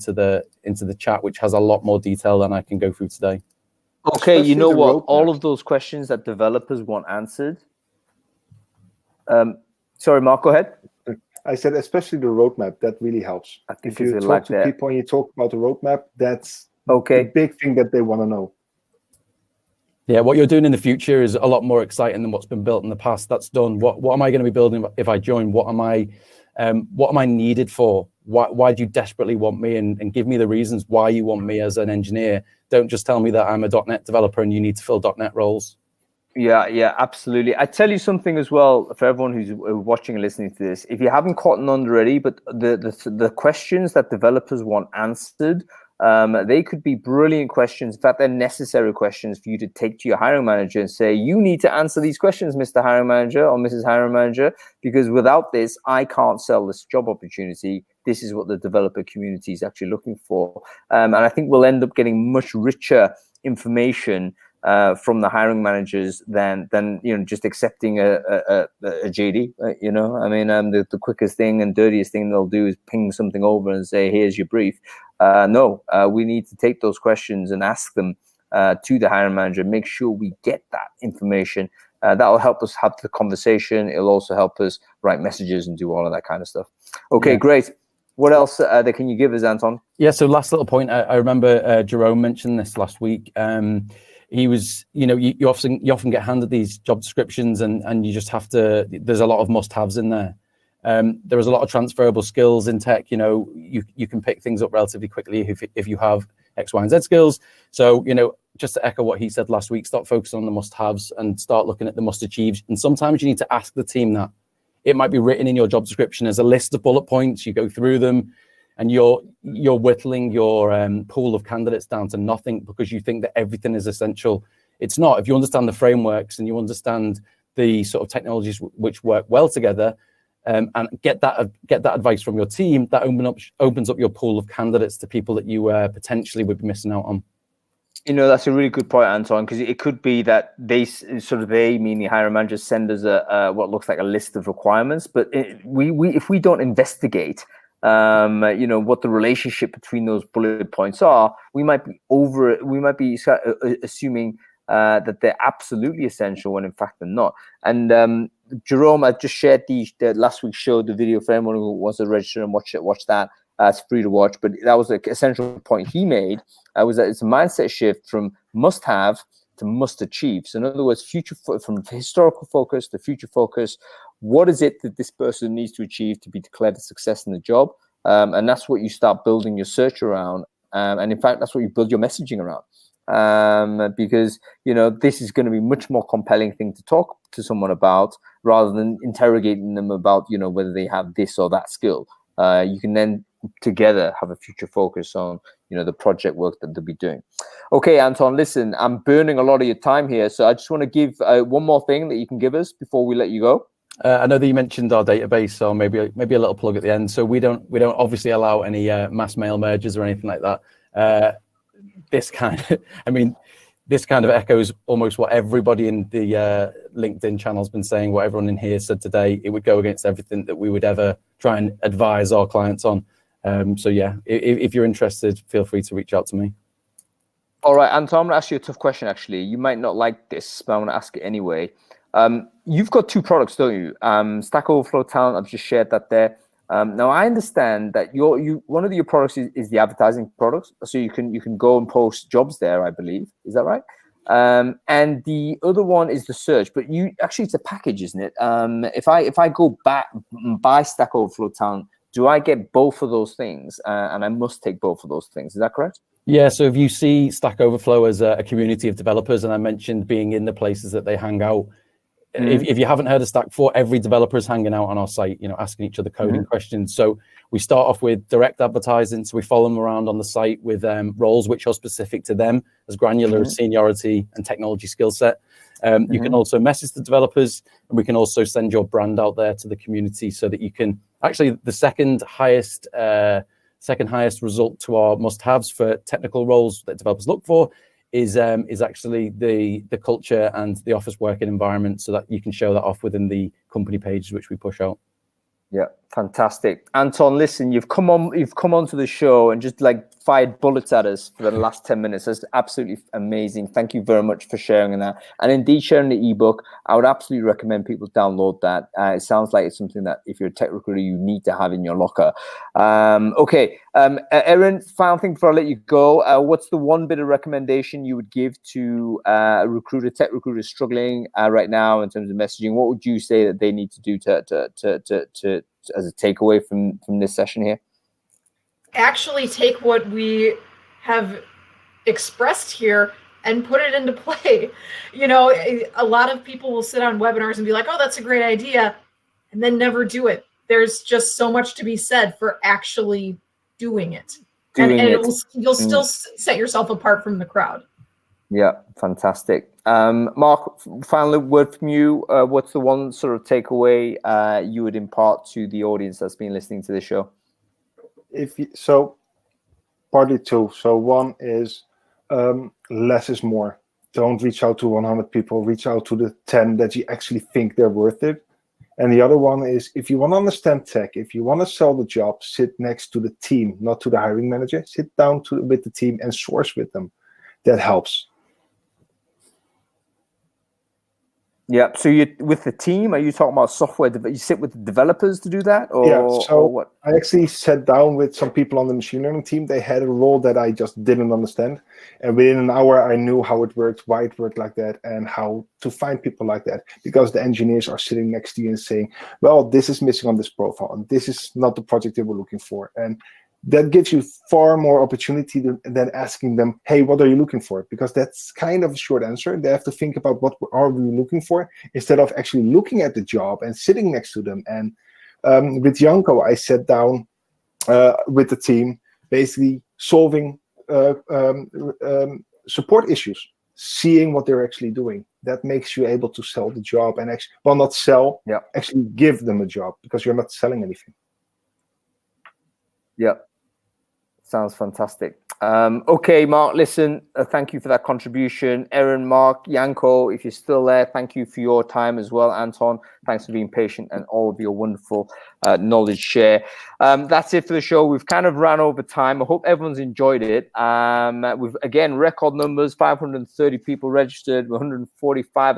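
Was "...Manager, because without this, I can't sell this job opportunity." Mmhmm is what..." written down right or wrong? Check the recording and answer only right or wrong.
wrong.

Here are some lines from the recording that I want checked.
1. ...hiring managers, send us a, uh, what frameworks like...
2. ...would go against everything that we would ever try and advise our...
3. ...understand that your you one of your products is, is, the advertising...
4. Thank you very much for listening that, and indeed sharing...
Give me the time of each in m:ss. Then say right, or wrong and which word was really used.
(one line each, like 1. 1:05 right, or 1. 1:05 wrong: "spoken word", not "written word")
1. 2:22 wrong: "looks", not "frameworks"
2. 3:39 right
3. 3:57 right
4. 5:03 wrong: "sharing", not "listening".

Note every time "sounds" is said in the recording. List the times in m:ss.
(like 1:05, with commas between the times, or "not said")
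5:09, 7:14.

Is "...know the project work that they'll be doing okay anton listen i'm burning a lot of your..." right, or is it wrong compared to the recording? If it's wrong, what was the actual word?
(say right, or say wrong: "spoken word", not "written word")
right.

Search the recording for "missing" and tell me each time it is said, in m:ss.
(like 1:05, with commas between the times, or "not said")
2:16, 6:40.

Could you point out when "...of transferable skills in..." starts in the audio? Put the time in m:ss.
1:41.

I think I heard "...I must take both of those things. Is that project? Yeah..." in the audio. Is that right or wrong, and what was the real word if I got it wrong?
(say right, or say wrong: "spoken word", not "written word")
wrong: "correct", not "project".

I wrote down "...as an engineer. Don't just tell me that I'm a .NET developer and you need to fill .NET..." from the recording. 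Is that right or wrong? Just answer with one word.
right.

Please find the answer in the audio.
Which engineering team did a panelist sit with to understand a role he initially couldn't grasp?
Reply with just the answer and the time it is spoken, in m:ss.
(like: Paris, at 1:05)
machine learning team, at 6:28.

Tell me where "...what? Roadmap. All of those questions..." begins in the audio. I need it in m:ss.
0:04.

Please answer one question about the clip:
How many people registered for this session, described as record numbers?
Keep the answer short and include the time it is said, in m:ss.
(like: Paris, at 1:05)
530, at 7:32.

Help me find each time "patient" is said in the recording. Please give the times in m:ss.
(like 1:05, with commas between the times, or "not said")
7:23.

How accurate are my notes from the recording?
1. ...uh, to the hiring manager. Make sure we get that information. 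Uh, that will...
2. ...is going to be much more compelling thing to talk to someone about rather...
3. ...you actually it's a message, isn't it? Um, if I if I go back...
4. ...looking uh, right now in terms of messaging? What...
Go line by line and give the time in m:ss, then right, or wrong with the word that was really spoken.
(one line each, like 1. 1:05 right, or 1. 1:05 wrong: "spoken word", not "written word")
1. 1:18 right
2. 3:05 right
3. 4:06 wrong: "package", not "message"
4. 5:20 wrong: "struggling", not "looking".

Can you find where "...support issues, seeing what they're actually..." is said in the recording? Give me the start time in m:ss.
7:02.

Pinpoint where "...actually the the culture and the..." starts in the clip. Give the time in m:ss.
4:48.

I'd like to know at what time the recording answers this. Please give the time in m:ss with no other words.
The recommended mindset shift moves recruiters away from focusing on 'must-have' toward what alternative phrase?
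2:49.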